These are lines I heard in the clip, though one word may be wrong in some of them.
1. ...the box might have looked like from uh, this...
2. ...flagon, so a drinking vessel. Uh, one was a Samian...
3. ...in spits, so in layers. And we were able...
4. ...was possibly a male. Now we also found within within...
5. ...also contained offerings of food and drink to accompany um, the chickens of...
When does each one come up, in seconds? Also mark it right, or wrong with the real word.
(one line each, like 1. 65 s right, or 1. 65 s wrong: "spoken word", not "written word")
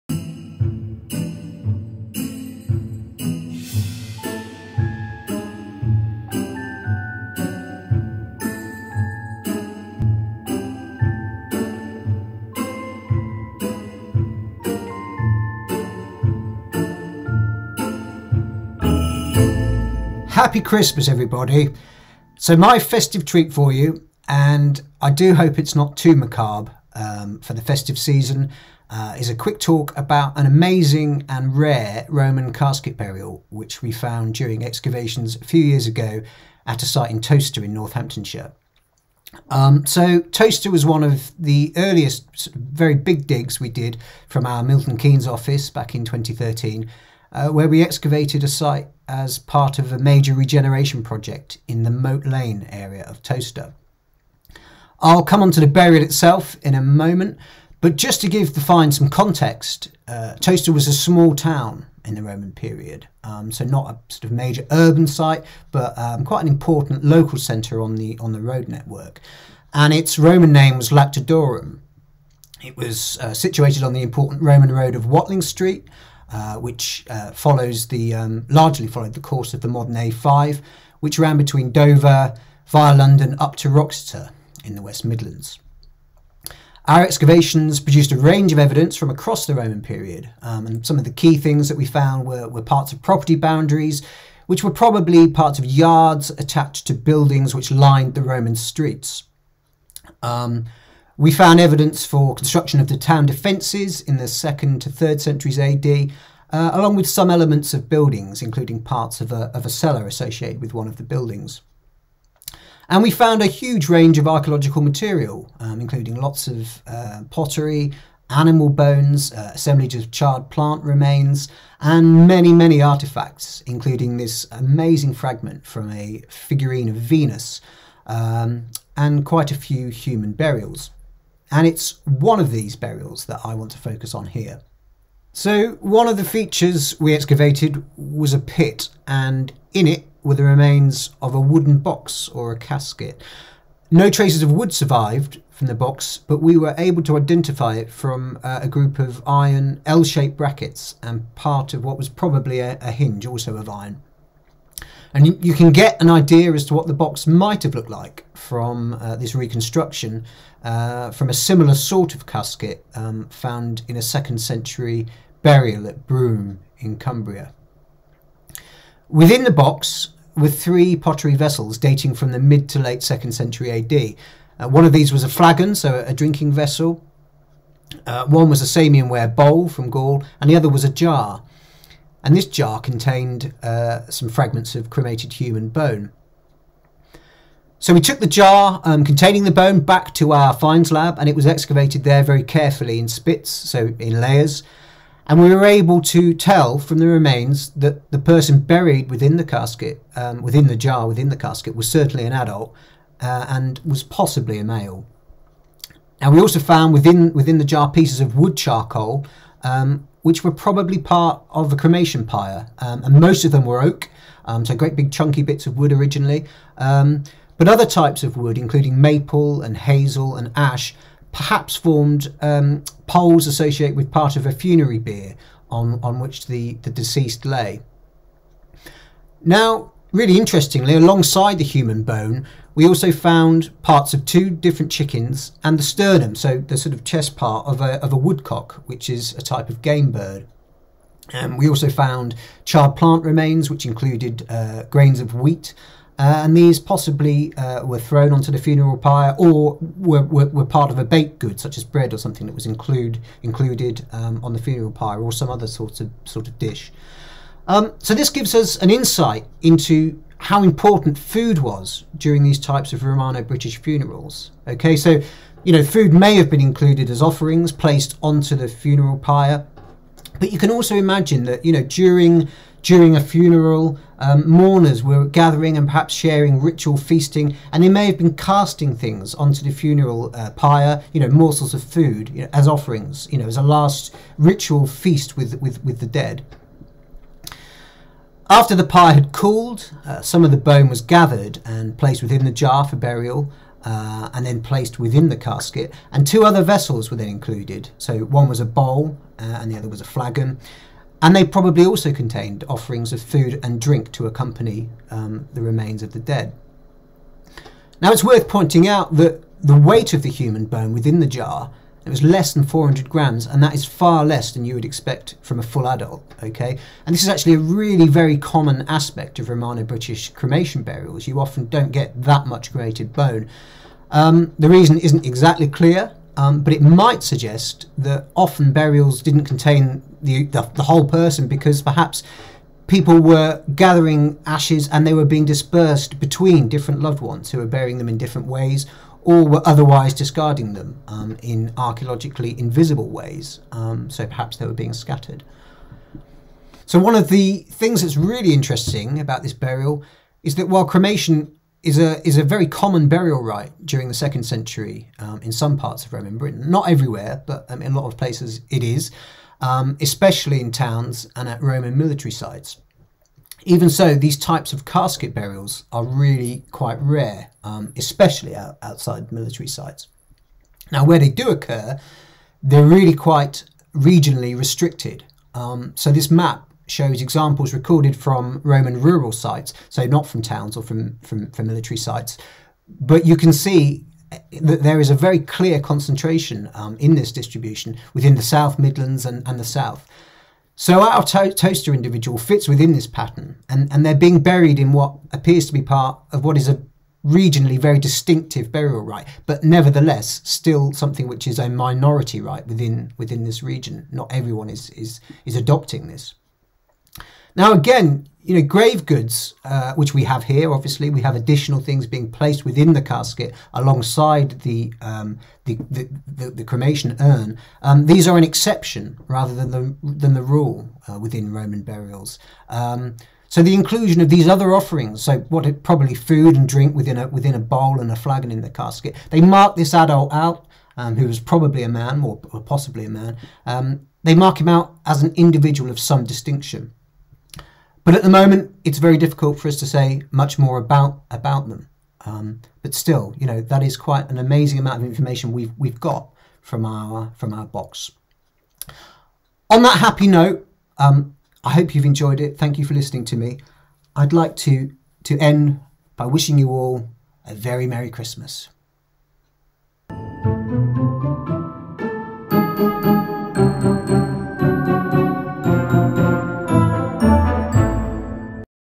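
1. 156 s right
2. 175 s right
3. 192 s right
4. 203 s right
5. 301 s wrong: "remains", not "chickens".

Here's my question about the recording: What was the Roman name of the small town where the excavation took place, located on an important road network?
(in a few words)
Lactodorum.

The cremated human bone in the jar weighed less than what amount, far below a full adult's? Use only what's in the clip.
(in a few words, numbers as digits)
400 grams.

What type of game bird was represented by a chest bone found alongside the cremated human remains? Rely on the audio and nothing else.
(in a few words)
woodcock.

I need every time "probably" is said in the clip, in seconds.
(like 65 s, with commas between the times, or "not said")
94 s, 152 s, 210 s, 301 s, 425 s, 431 s.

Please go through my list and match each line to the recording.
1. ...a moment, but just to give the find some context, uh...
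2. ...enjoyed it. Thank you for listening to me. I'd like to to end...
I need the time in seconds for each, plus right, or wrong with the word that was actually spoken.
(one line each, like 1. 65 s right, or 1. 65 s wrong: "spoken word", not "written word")
1. 56 s right
2. 452 s right.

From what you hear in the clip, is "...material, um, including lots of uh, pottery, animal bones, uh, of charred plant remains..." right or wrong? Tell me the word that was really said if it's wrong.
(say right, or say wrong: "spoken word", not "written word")
right.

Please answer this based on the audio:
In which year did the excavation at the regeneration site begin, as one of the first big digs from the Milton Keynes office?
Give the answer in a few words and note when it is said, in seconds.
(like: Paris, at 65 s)
2013, at 46 s.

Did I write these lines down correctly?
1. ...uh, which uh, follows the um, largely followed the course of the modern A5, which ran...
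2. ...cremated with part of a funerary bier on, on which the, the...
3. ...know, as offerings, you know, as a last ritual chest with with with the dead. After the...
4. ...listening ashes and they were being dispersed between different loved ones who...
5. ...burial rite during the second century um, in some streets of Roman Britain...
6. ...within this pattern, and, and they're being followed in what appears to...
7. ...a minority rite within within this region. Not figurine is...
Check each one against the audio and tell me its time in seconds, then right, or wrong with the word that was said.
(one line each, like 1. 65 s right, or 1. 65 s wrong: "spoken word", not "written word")
1. 76 s right
2. 223 s wrong: "associated", not "cremated"
3. 282 s wrong: "feast", not "chest"
4. 333 s wrong: "gathering", not "listening"
5. 353 s wrong: "parts", not "streets"
6. 392 s wrong: "buried", not "followed"
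7. 401 s wrong: "everyone", not "figurine".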